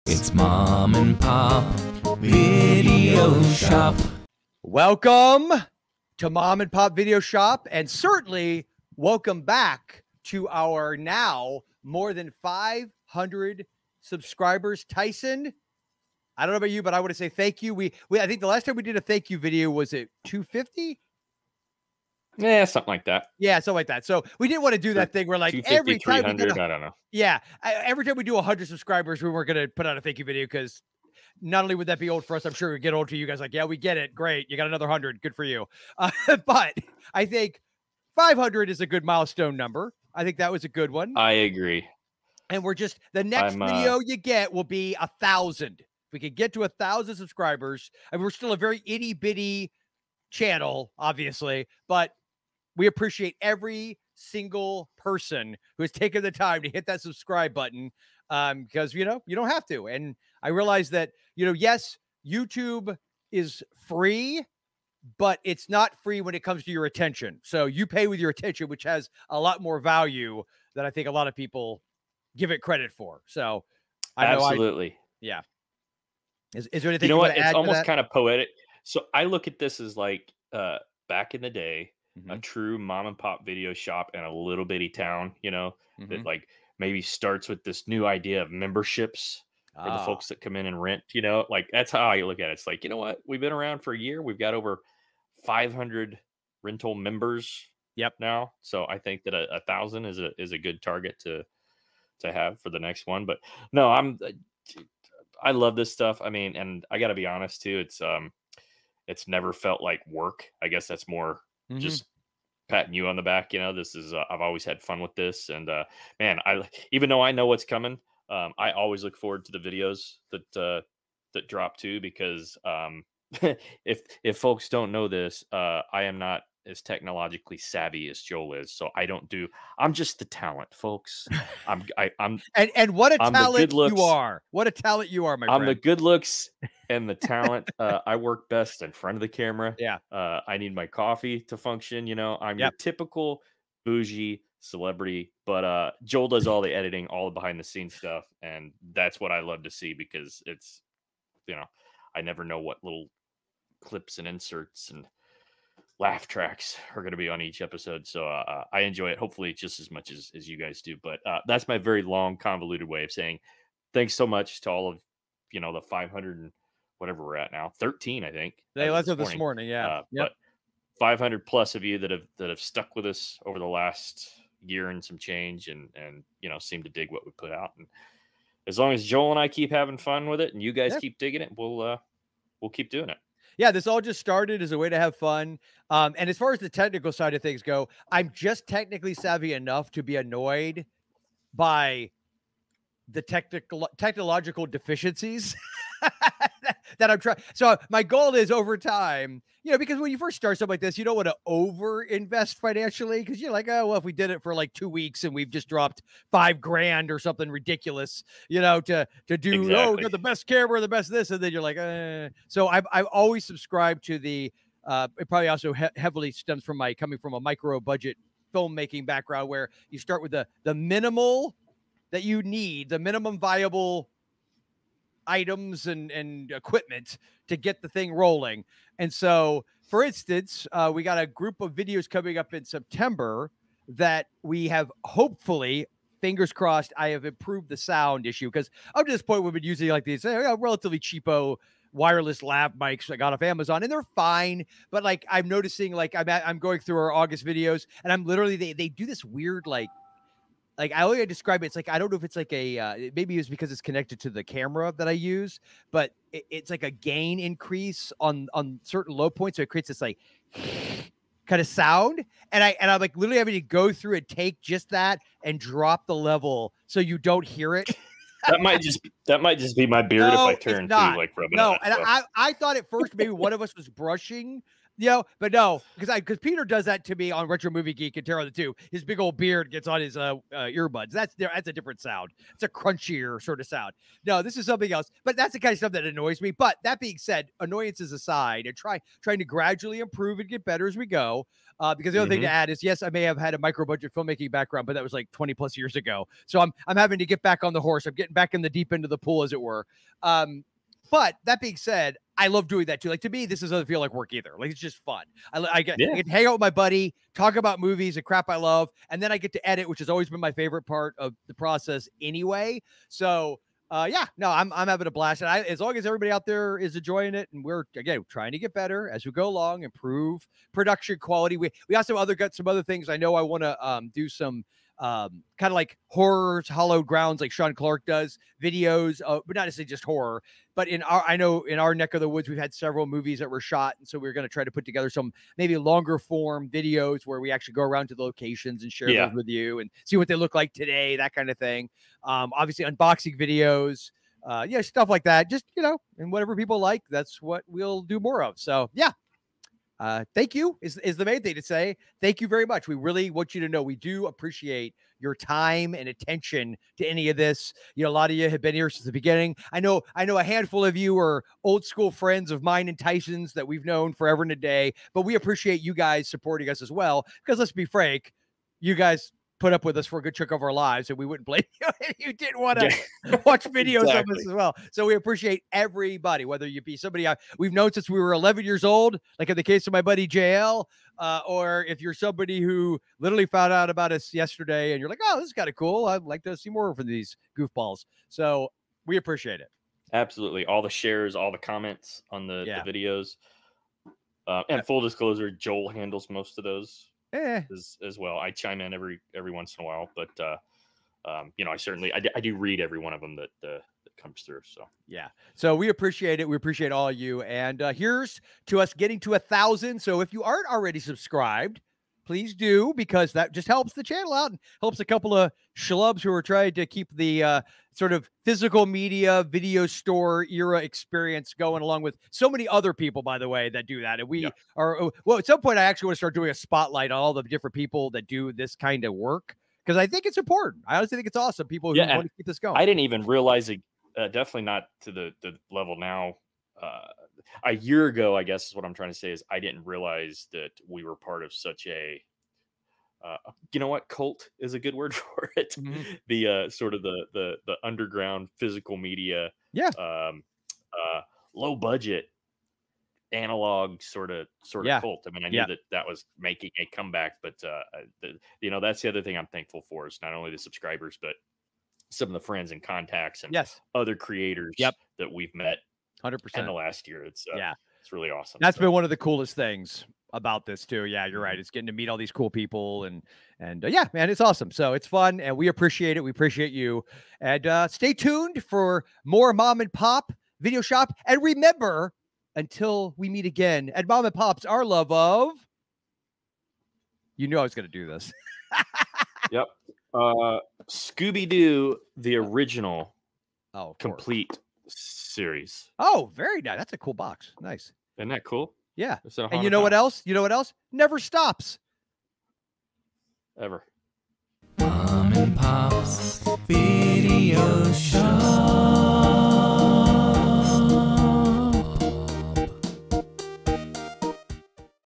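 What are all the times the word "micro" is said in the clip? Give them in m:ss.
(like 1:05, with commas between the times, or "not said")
3:37, 4:53.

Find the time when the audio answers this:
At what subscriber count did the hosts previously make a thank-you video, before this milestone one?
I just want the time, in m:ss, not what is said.
0:20.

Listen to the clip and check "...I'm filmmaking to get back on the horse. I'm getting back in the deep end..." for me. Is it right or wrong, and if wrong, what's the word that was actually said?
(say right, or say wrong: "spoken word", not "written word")
wrong: "having", not "filmmaking".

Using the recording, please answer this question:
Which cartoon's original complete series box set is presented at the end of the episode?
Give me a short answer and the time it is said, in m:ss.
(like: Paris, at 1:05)
Scooby Doo, at 8:10.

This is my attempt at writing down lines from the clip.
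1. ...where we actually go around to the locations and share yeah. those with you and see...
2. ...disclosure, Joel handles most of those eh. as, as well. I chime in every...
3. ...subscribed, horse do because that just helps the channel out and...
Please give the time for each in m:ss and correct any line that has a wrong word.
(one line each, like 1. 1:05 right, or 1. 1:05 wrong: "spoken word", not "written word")
1. 5:37 right
2. 6:35 right
3. 6:50 wrong: "please", not "horse".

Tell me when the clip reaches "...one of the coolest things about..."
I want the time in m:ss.
7:48.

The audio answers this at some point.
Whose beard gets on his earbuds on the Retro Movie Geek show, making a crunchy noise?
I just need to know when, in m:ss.
4:36.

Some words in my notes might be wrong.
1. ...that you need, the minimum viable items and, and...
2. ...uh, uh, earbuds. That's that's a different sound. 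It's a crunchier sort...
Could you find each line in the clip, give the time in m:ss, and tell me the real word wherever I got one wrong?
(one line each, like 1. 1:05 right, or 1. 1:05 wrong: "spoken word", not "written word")
1. 3:42 right
2. 4:40 right.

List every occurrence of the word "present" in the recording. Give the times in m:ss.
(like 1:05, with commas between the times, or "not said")
not said.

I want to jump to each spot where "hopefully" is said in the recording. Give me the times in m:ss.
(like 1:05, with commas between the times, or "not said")
2:39, 3:55.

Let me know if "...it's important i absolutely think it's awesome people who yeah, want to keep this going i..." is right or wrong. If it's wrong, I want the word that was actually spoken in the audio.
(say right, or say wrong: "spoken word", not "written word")
wrong: "honestly", not "absolutely".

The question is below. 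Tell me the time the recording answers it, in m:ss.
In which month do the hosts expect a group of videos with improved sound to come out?
3:52.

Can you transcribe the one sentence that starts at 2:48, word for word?
They left this, this morning, yeah.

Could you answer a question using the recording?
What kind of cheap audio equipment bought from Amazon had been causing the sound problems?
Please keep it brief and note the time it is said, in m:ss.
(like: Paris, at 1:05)
Wireless lav mics, at 4:01.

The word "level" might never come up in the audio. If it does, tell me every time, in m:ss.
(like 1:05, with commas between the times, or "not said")
4:26, 7:15.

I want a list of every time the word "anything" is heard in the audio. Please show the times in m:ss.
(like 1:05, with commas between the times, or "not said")
1:16.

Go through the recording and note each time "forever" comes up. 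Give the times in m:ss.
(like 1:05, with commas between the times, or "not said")
6:04.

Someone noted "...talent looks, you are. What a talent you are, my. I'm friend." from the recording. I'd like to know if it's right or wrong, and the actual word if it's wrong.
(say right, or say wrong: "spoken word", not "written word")
right.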